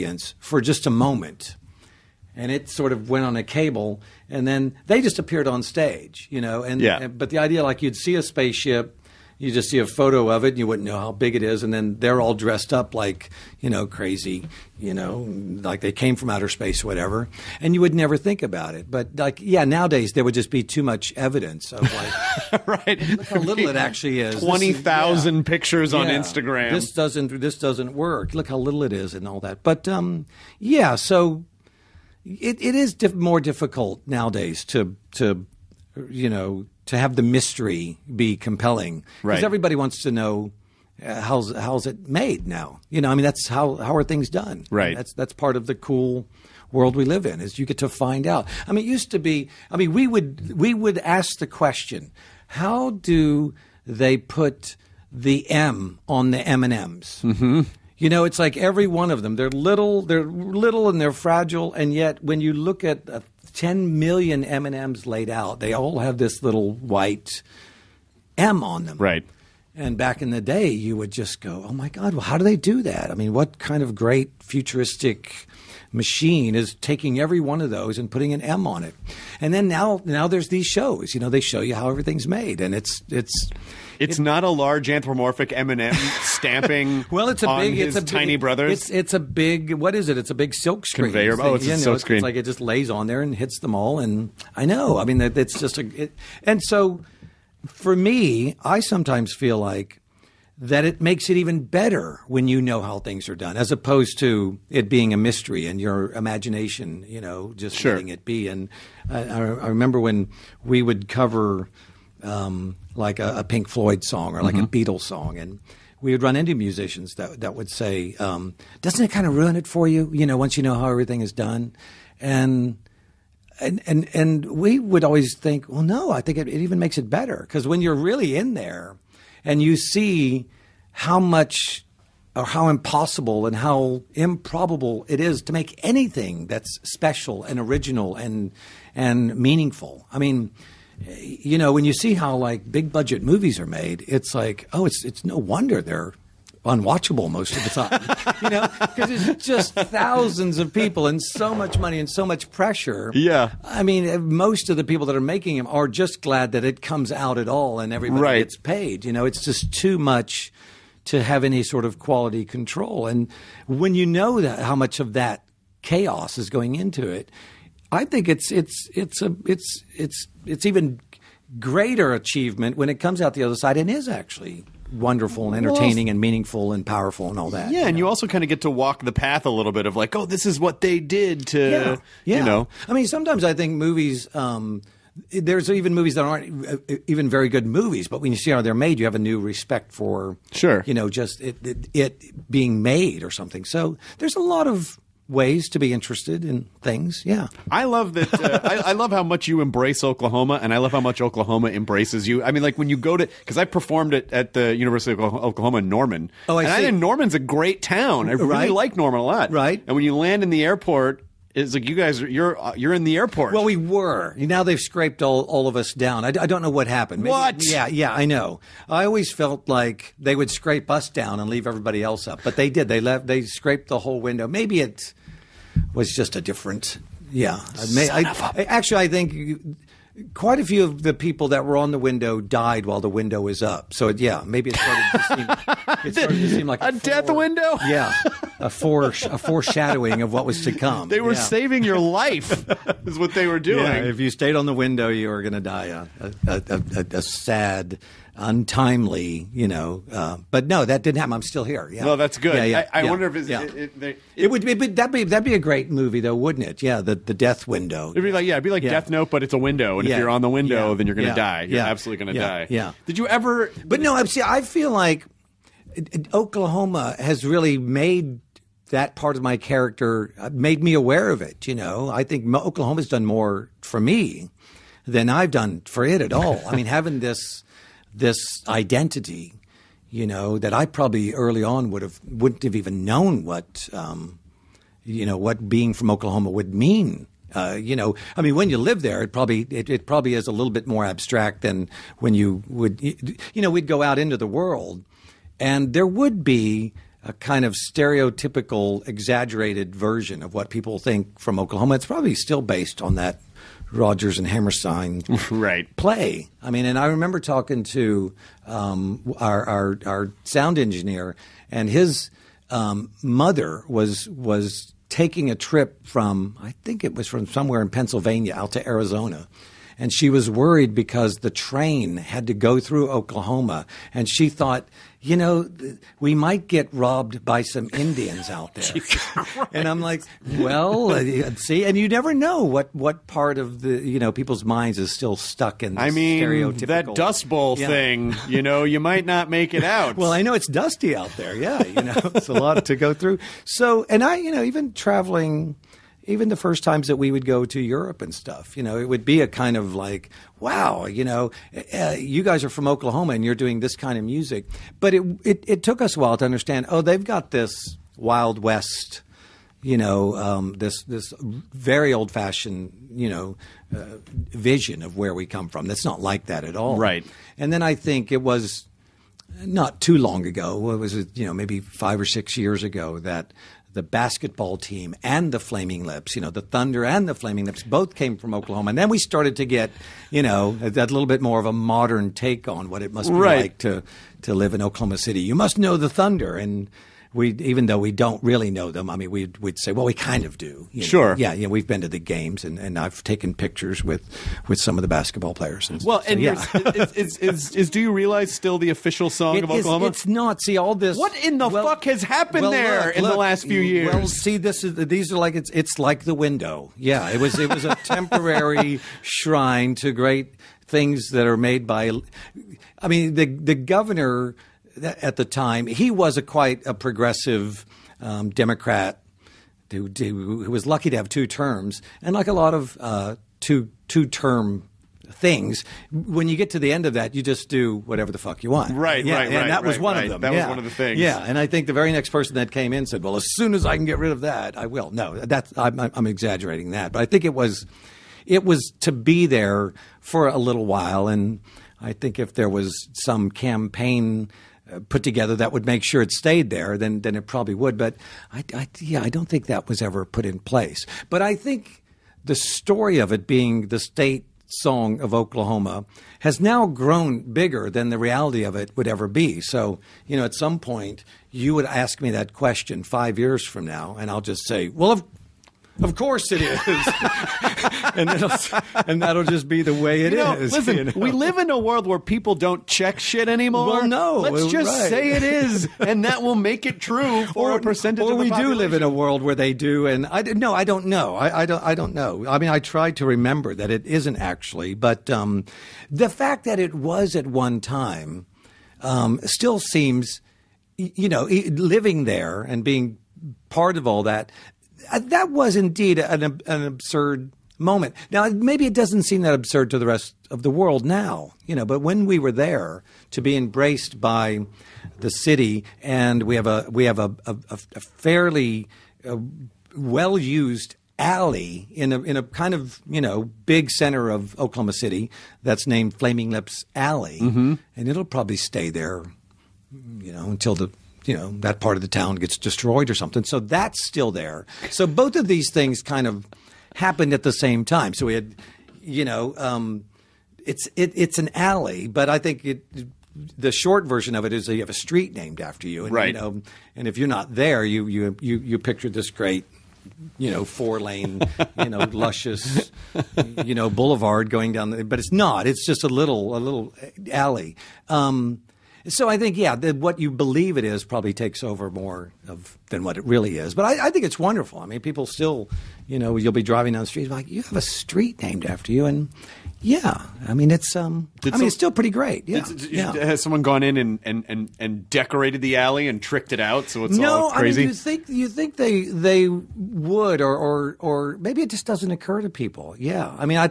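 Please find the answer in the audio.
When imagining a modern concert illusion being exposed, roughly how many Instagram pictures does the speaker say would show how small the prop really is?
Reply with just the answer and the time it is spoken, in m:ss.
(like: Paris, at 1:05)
20,000, at 0:24.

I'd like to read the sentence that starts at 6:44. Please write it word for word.
Well, see, this is, these are like, it's, it's like the window.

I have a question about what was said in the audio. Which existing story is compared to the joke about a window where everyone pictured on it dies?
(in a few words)
Death Note.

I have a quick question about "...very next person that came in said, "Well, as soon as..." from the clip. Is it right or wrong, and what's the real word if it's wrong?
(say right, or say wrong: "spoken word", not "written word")
right.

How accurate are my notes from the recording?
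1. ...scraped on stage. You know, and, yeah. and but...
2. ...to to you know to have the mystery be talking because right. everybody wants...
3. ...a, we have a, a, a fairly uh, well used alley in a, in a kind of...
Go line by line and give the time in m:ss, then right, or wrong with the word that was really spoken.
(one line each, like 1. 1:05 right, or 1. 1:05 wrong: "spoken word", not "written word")
1. 0:05 wrong: "appeared", not "scraped"
2. 0:34 wrong: "compelling", not "talking"
3. 8:26 right.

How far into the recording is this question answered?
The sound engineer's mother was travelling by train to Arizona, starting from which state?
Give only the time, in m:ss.
5:17.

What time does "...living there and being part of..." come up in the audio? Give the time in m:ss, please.
8:11.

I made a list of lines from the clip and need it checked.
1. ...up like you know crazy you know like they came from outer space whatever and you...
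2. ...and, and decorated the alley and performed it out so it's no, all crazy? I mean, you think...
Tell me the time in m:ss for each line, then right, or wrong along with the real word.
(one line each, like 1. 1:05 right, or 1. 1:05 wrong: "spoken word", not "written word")
1. 0:12 right
2. 9:24 wrong: "tricked", not "performed".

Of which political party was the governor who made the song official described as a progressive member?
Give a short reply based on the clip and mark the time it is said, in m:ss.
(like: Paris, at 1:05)
Democrat, at 6:58.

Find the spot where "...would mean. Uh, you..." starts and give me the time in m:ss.
4:46.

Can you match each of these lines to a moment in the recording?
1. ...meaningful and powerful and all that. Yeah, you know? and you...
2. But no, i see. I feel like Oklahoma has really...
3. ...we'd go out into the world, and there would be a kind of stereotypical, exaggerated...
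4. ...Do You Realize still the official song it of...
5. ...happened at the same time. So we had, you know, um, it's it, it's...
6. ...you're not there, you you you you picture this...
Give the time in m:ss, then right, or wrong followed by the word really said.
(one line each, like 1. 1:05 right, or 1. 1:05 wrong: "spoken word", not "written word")
1. 2:56 right
2. 4:23 right
3. 4:53 right
4. 6:37 right
5. 8:46 right
6. 8:57 right.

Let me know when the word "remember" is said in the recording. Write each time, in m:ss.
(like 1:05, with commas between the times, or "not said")
1:49, 5:07, 8:03.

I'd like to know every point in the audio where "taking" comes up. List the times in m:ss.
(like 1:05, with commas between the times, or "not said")
1:16, 5:15.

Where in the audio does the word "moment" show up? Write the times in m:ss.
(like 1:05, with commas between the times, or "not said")
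0:00, 8:17.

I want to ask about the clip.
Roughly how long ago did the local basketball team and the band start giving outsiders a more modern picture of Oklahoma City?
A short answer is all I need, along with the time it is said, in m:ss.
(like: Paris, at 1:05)
5 or 6 years, at 6:11.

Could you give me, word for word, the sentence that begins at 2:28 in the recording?
you know, because it's just thousands of people and so much money and so much pressure.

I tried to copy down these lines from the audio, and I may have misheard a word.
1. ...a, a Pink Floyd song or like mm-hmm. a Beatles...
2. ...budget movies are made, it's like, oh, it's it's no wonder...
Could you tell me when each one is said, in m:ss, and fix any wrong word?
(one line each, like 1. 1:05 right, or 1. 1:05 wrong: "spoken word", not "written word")
1. 1:53 right
2. 2:22 right.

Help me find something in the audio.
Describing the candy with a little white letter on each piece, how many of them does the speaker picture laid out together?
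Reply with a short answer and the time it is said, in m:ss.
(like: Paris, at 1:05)
10 million, at 1:03.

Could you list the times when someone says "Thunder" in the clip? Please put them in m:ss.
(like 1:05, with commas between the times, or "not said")
6:16, 6:26.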